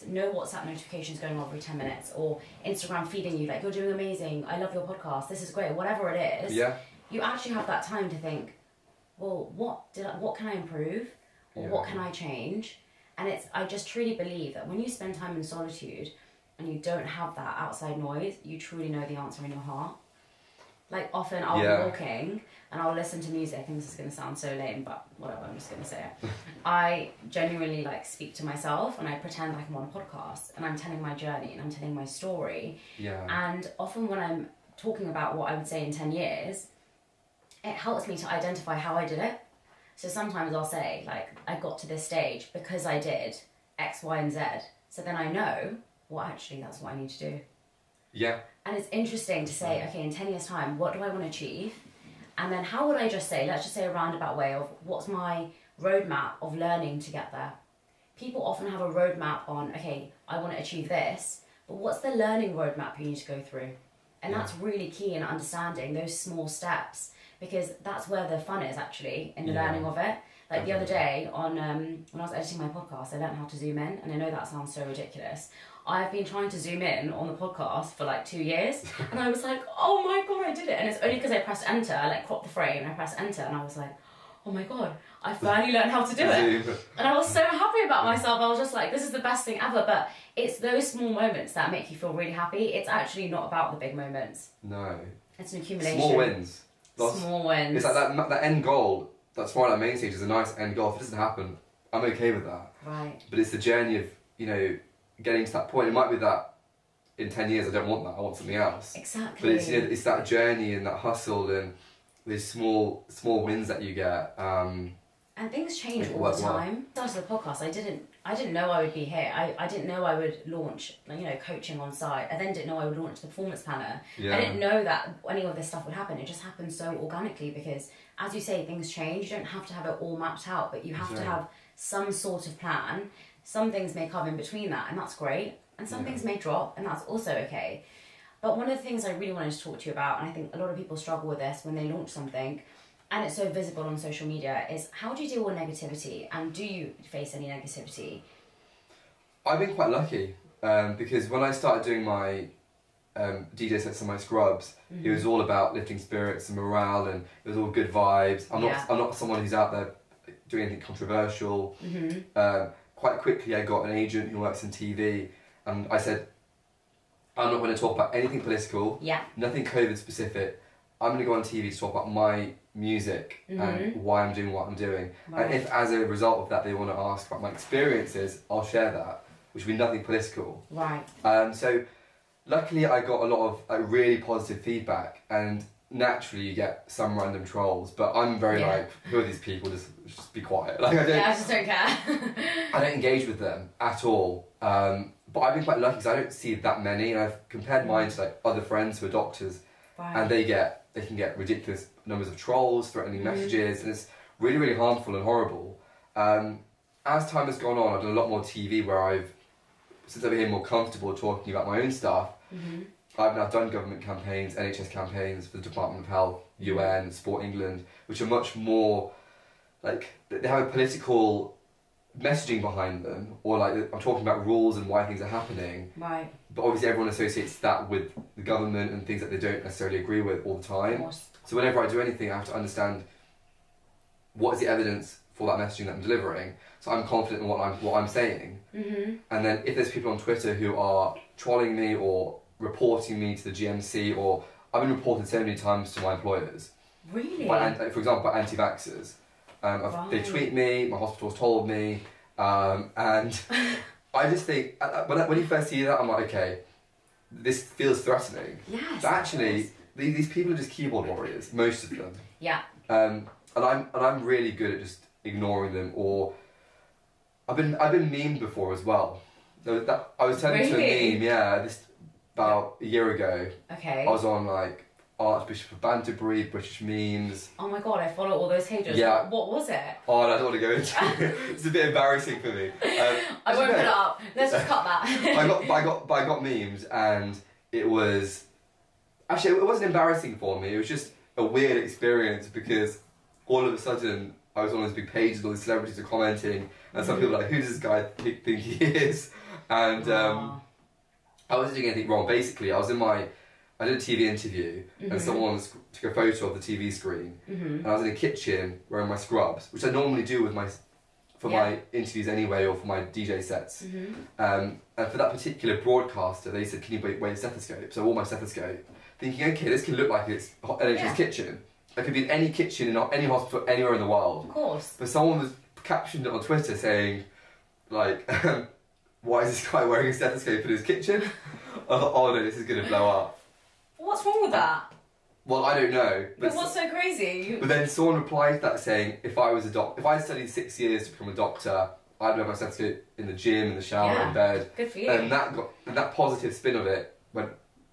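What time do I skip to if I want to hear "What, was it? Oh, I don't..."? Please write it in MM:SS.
04:39.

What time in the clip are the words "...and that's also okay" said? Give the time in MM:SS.
02:16.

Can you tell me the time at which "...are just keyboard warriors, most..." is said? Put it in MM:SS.
04:20.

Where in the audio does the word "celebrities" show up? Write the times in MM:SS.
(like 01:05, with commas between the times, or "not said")
04:55.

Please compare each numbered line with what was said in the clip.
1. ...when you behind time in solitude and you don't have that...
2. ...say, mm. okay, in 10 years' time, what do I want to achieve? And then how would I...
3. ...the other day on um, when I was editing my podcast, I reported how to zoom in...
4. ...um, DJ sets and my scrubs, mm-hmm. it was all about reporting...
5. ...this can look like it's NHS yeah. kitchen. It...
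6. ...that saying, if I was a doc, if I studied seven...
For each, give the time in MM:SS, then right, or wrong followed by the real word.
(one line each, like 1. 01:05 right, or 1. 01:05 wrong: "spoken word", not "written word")
1. 00:14 wrong: "spend", not "behind"
2. 00:49 right
3. 01:10 wrong: "learned", not "reported"
4. 02:33 wrong: "lifting", not "reporting"
5. 05:19 right
6. 05:38 wrong: "six", not "seven".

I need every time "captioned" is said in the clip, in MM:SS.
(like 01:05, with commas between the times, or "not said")
05:25.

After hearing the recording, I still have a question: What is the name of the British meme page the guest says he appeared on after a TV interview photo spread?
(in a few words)
Archbishop of Banterbury.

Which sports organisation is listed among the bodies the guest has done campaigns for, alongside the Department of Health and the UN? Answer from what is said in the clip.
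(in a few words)
Sport England.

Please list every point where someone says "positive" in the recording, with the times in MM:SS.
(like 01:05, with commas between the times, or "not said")
03:04, 05:46.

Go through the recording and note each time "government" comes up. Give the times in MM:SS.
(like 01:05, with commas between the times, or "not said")
03:33, 03:48.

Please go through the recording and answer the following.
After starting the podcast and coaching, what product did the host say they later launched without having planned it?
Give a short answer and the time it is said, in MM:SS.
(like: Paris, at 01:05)
the performance planner, at 02:03.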